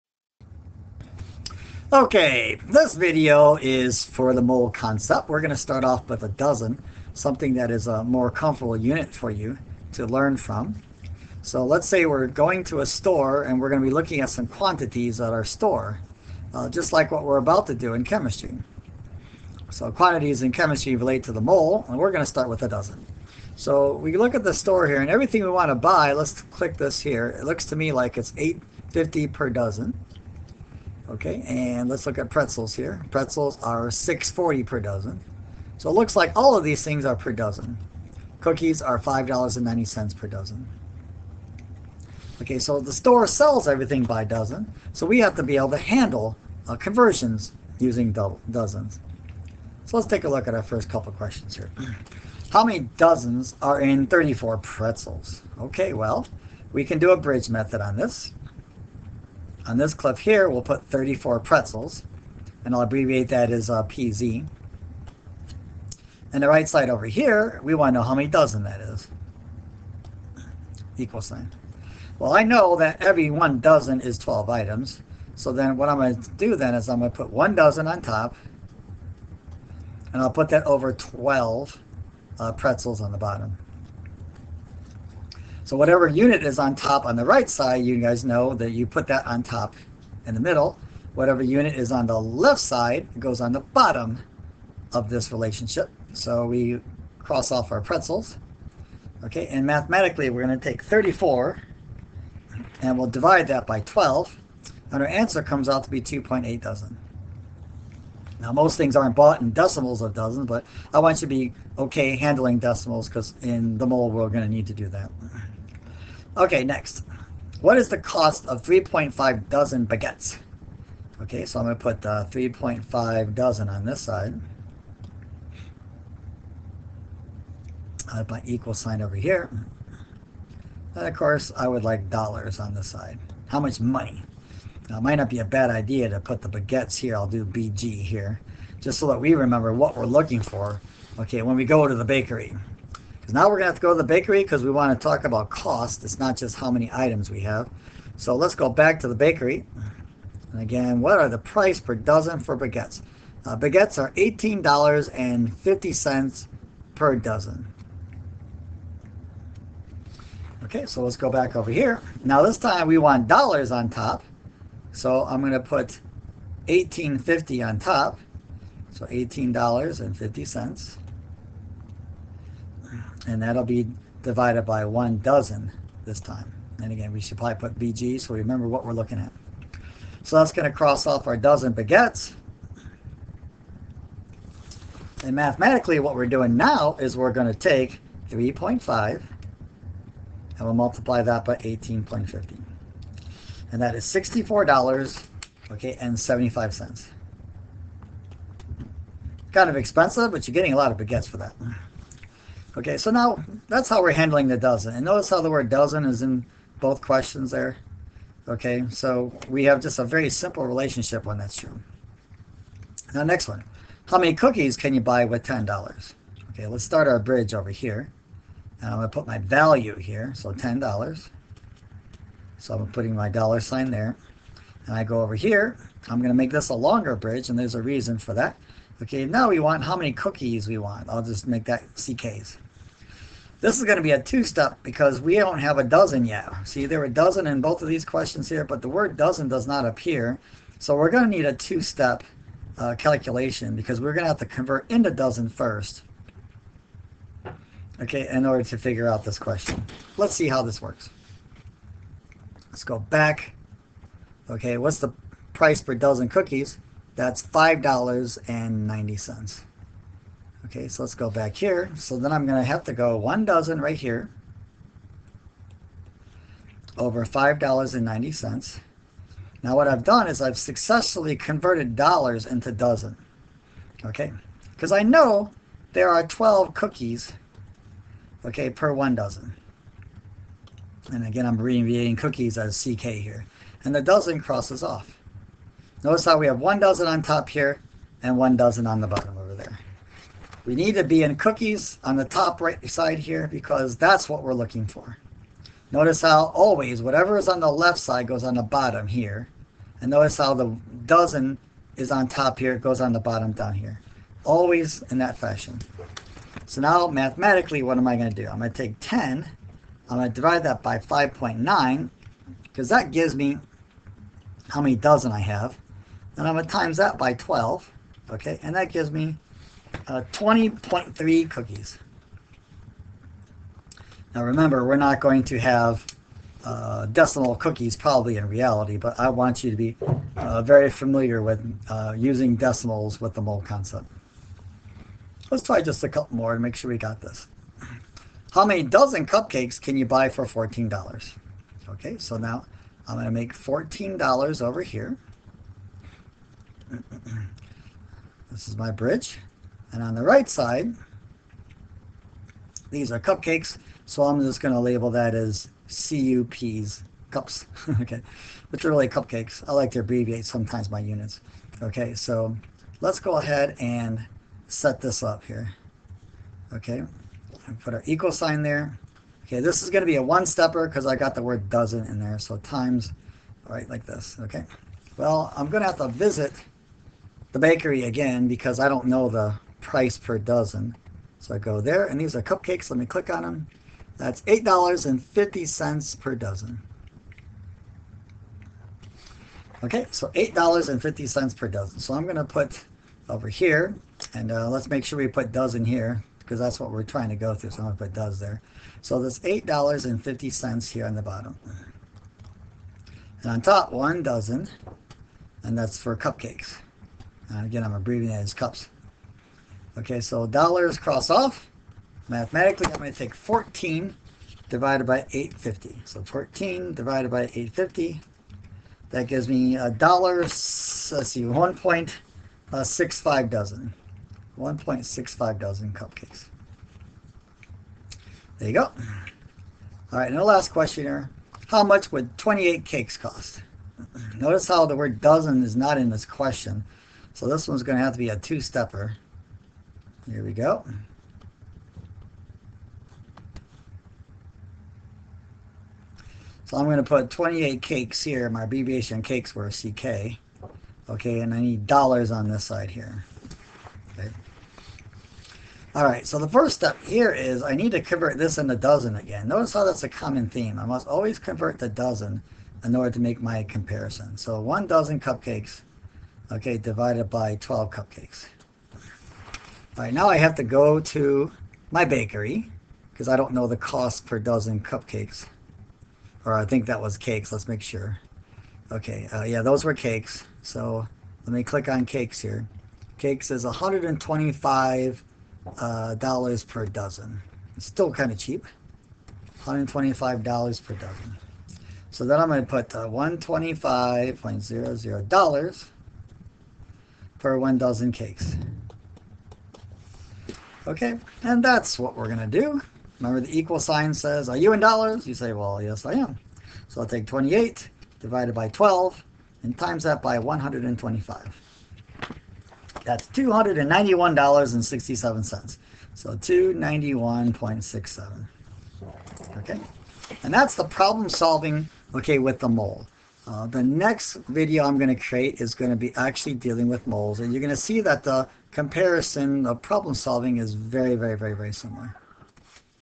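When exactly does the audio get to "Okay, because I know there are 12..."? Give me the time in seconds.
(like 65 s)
274 s.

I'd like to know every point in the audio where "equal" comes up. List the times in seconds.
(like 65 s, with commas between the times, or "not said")
70 s, 128 s, 368 s, 503 s.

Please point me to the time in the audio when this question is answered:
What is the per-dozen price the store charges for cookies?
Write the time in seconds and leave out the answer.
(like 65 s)
38 s.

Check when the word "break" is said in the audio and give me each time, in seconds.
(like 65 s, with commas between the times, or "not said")
not said.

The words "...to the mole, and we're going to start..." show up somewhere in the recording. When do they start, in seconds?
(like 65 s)
21 s.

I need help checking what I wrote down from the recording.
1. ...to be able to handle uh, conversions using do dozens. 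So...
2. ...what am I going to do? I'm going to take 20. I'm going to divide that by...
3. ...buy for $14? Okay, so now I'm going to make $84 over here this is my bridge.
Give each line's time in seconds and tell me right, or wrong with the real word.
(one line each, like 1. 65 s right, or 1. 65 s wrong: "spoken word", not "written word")
1. 45 s right
2. 307 s wrong: "10", not "20"
3. 340 s wrong: "14", not "84".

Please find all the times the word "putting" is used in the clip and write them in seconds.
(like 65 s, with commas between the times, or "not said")
222 s.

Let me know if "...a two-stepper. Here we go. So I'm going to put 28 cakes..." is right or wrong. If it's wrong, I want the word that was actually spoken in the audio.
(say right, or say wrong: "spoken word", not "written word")
right.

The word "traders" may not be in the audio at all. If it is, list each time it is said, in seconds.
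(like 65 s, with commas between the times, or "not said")
not said.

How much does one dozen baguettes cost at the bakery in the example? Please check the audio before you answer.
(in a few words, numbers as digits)
$18.50.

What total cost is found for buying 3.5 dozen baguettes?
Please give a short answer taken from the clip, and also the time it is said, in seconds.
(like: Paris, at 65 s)
$64.75, at 194 s.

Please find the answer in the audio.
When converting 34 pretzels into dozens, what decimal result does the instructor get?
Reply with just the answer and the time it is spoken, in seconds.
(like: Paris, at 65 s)
2.8 dozen, at 106 s.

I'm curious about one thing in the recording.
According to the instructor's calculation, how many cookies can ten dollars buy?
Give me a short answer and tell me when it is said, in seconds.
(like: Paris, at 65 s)
20.3, at 320 s.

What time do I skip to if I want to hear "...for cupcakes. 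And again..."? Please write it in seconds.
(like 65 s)
405 s.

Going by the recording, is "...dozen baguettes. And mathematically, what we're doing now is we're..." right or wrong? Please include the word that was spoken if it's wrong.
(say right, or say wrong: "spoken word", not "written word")
right.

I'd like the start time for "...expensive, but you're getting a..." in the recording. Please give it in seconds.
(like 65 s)
199 s.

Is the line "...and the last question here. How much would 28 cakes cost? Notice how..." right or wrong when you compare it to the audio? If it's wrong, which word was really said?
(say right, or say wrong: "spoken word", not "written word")
right.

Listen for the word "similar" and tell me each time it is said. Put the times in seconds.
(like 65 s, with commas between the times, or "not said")
531 s.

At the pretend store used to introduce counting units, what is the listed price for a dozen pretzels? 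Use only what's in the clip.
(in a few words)
$6.40.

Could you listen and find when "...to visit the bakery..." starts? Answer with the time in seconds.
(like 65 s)
375 s.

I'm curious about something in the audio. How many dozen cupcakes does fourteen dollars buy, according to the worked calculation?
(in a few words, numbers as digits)
1.65 dozen.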